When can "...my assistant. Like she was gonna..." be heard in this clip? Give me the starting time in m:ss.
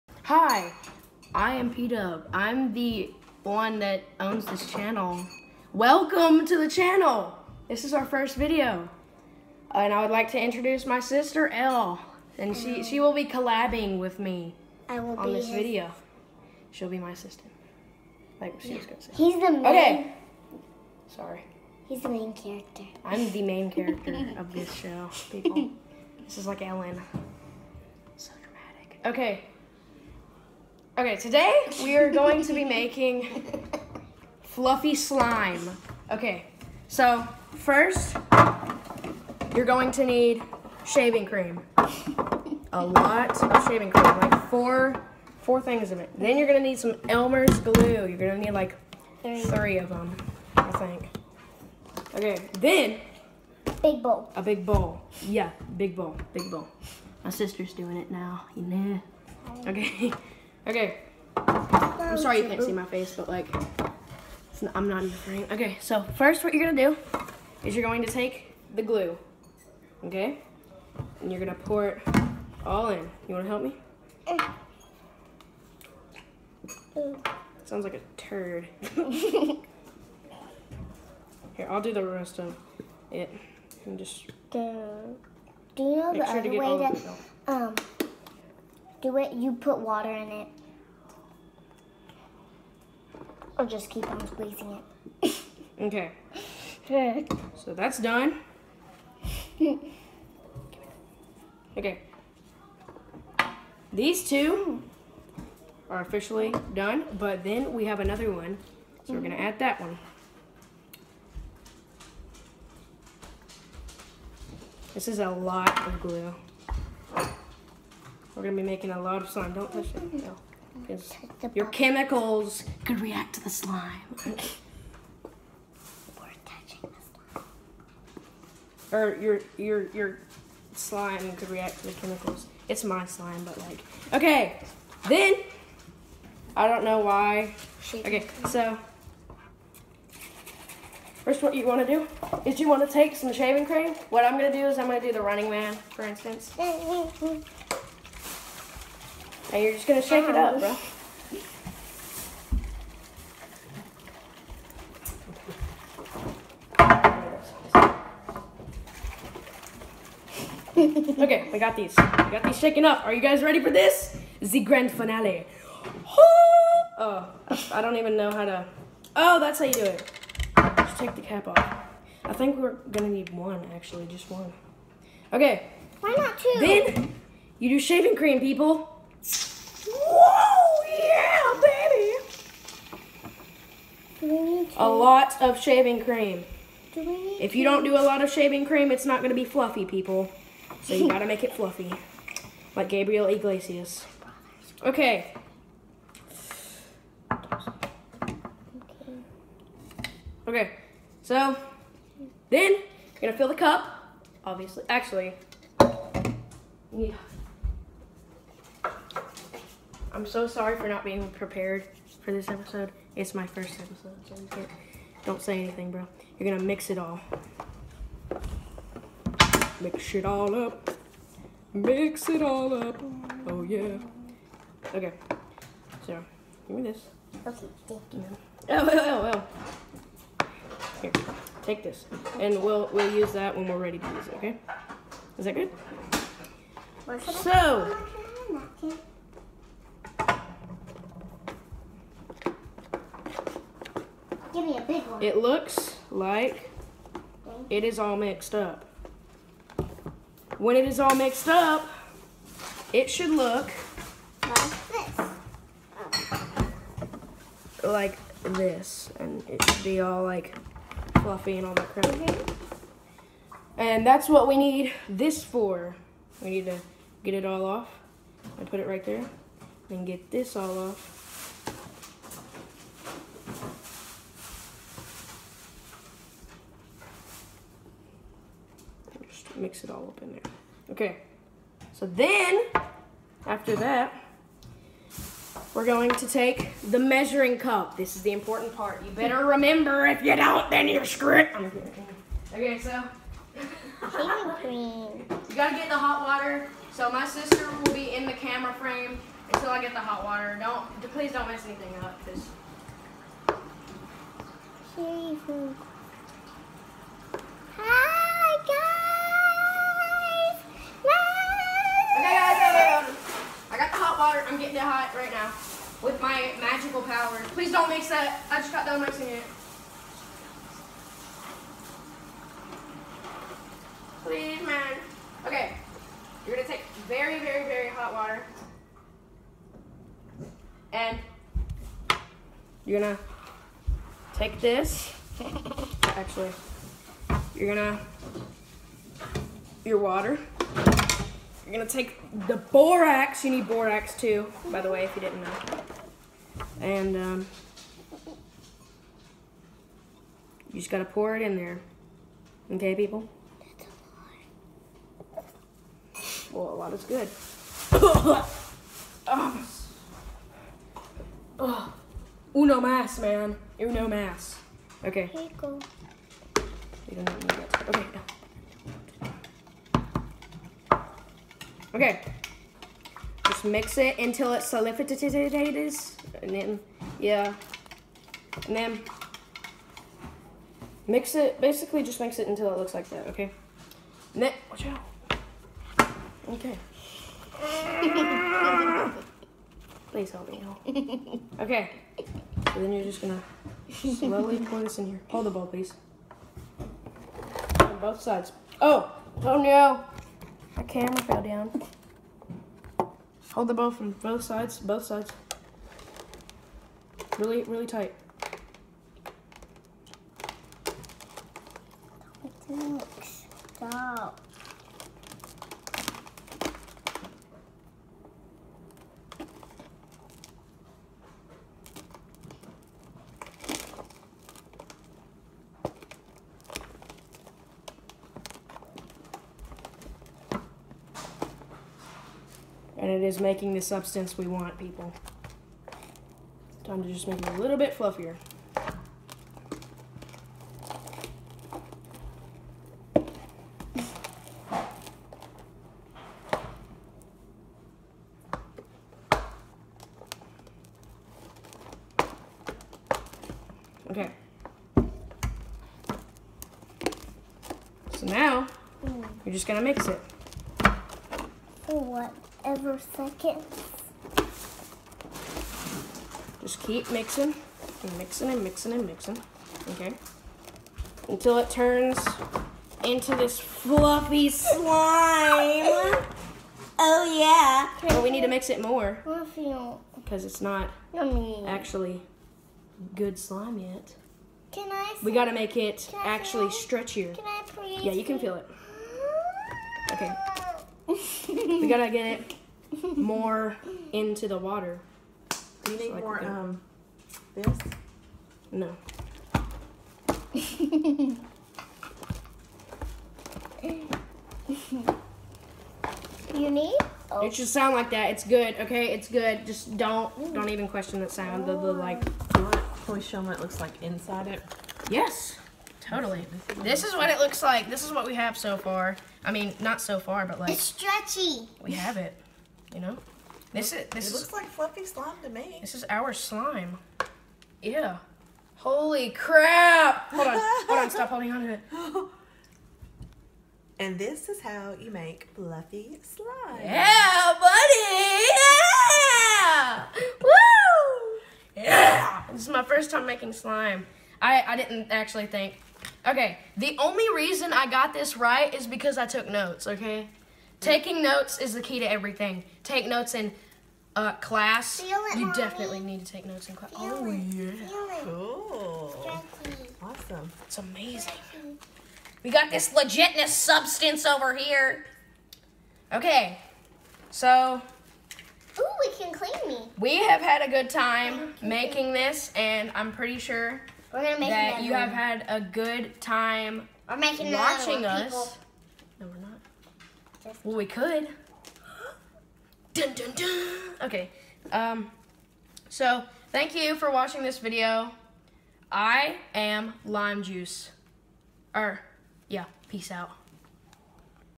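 0:16.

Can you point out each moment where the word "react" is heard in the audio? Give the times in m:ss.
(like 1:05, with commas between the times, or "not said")
2:03, 2:11.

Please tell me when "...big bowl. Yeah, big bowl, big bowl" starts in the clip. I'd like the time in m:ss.
0:54.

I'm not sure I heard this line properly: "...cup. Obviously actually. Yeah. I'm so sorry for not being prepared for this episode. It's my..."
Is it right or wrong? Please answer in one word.
right.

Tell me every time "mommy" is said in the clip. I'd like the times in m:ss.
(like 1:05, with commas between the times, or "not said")
9:15.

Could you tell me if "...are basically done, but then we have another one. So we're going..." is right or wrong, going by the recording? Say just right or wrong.
wrong.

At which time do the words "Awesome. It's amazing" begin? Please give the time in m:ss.
9:20.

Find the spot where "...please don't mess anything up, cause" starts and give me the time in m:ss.
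5:01.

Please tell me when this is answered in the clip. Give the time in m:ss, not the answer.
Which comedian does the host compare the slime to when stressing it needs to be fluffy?
3:12.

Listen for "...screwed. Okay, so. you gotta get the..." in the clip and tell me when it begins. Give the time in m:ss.
4:51.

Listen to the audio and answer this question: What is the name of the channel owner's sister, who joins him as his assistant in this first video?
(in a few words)
Elle.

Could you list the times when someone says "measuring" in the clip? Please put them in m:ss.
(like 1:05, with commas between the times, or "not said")
4:46.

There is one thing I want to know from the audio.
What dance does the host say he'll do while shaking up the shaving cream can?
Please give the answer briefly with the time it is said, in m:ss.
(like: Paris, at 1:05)
running man, at 2:25.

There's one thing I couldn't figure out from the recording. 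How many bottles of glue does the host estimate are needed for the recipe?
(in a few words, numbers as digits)
3.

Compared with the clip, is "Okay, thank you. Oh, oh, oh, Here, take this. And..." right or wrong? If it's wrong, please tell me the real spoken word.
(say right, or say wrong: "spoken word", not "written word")
right.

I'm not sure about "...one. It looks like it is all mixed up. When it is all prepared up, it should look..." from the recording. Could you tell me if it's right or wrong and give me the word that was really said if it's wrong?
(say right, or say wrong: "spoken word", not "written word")
wrong: "mixed", not "prepared".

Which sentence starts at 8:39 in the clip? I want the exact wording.
I mean, not so far, but like.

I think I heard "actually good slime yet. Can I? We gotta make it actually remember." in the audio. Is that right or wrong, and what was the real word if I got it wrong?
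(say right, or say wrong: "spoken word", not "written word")
wrong: "stretchier", not "remember".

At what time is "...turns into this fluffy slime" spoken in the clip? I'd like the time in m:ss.
7:51.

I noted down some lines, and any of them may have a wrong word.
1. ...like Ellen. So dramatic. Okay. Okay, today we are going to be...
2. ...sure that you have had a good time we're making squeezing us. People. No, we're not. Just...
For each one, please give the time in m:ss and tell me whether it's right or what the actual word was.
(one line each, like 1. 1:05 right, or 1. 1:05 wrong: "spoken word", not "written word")
1. 0:26 right
2. 9:33 wrong: "watching", not "squeezing".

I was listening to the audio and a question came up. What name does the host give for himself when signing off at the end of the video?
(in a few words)
Lime Juice.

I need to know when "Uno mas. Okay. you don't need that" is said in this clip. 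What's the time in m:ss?
6:03.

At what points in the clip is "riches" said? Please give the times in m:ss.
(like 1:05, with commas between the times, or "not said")
not said.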